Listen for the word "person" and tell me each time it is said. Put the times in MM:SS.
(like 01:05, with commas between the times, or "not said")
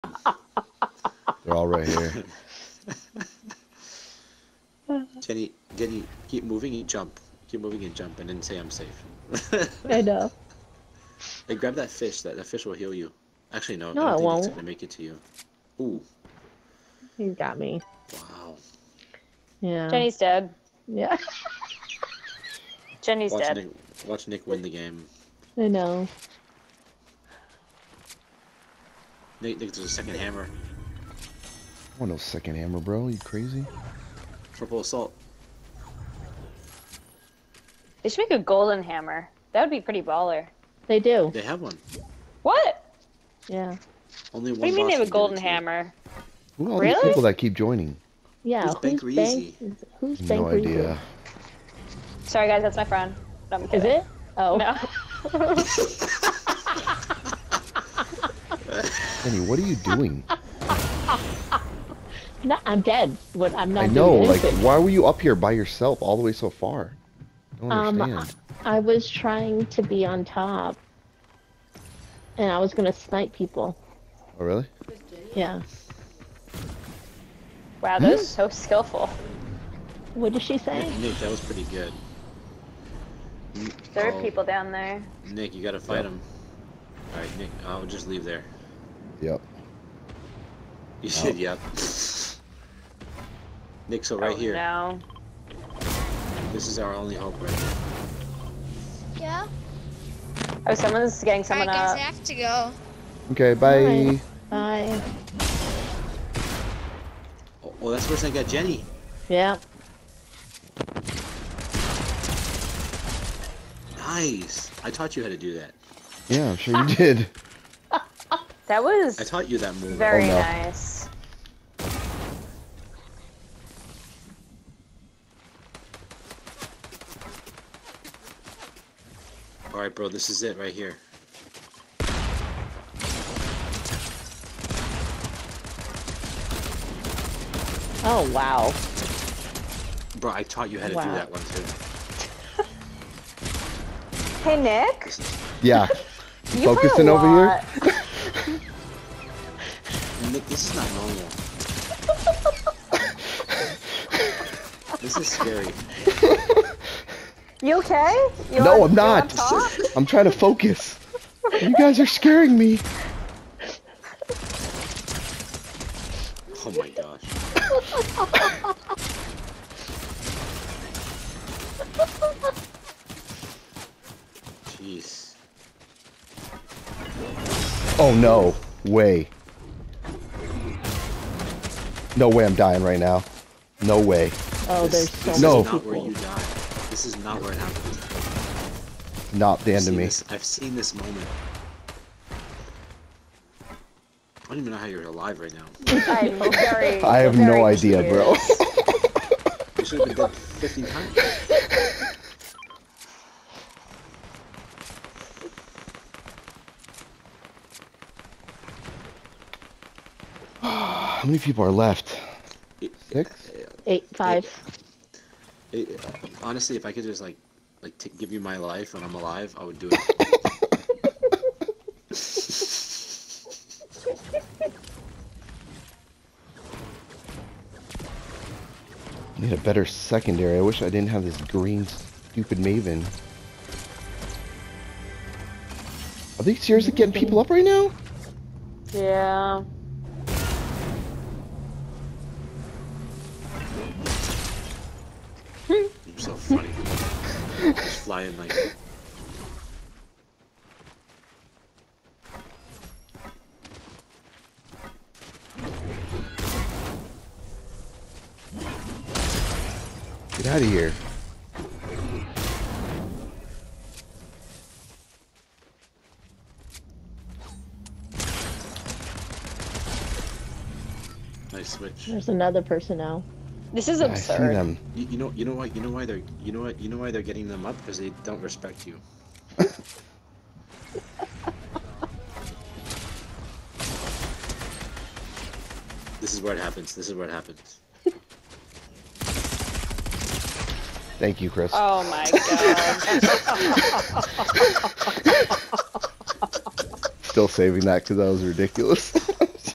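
04:32.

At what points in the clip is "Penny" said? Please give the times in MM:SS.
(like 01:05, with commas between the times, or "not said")
00:59.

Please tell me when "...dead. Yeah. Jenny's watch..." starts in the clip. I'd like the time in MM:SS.
00:20.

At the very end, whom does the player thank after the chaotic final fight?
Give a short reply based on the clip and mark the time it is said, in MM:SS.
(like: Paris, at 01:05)
Chris, at 04:51.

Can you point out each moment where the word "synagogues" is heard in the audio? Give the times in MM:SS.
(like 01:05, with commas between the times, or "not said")
not said.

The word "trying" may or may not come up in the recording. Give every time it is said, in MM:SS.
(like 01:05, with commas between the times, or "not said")
01:09, 02:40.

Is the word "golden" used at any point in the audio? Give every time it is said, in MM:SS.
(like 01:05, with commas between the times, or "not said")
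00:38, 00:45.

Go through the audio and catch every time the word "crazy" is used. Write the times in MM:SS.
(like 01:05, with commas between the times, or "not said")
00:33.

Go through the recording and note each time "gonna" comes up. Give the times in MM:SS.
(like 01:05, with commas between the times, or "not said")
00:14, 01:12.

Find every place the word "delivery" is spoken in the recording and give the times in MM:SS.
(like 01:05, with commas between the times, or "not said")
not said.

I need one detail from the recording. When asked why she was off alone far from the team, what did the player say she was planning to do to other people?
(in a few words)
Snipe people.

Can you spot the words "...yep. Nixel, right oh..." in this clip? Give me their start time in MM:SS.
01:31.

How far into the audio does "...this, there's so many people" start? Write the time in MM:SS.
03:04.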